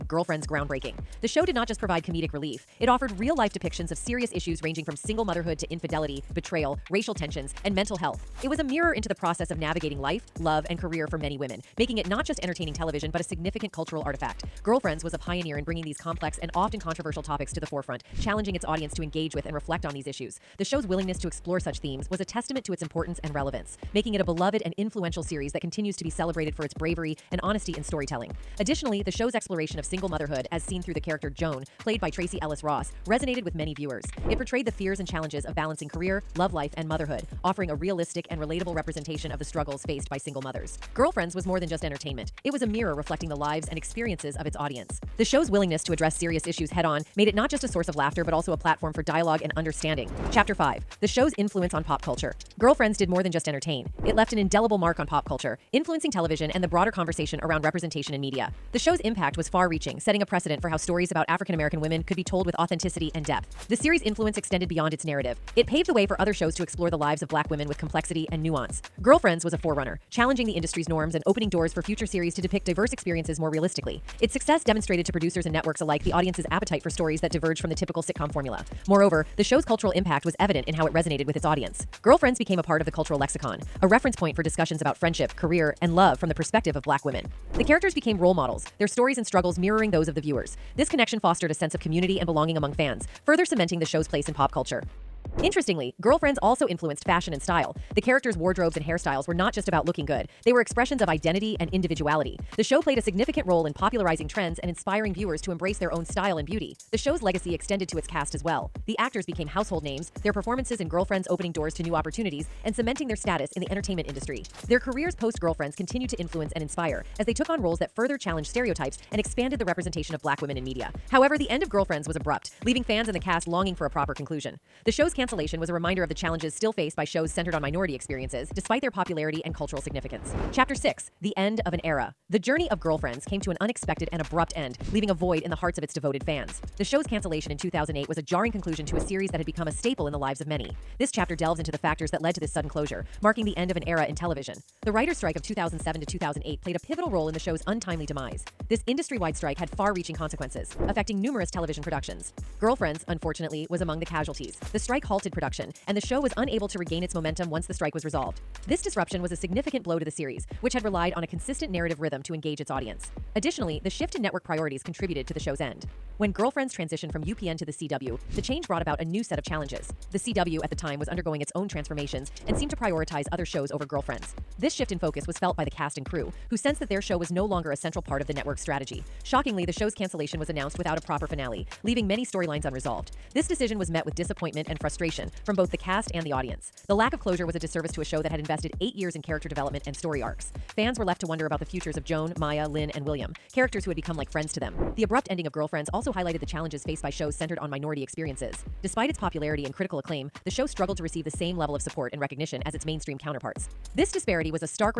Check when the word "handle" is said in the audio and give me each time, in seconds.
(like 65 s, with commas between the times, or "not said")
not said.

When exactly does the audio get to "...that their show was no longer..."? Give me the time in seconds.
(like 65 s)
176 s.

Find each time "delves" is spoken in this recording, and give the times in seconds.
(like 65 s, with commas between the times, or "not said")
141 s.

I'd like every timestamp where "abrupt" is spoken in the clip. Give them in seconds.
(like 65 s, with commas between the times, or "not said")
122 s, 134 s, 195 s.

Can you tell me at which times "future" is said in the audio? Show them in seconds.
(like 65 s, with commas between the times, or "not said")
71 s, 191 s.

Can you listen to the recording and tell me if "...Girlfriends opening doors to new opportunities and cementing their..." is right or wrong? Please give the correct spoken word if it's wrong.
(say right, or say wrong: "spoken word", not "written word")
right.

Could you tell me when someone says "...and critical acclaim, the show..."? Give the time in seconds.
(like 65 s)
199 s.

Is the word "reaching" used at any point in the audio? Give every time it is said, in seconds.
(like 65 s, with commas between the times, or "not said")
59 s, 149 s.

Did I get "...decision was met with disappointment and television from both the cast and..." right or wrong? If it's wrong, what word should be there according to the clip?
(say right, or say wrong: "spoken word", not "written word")
wrong: "frustration", not "television".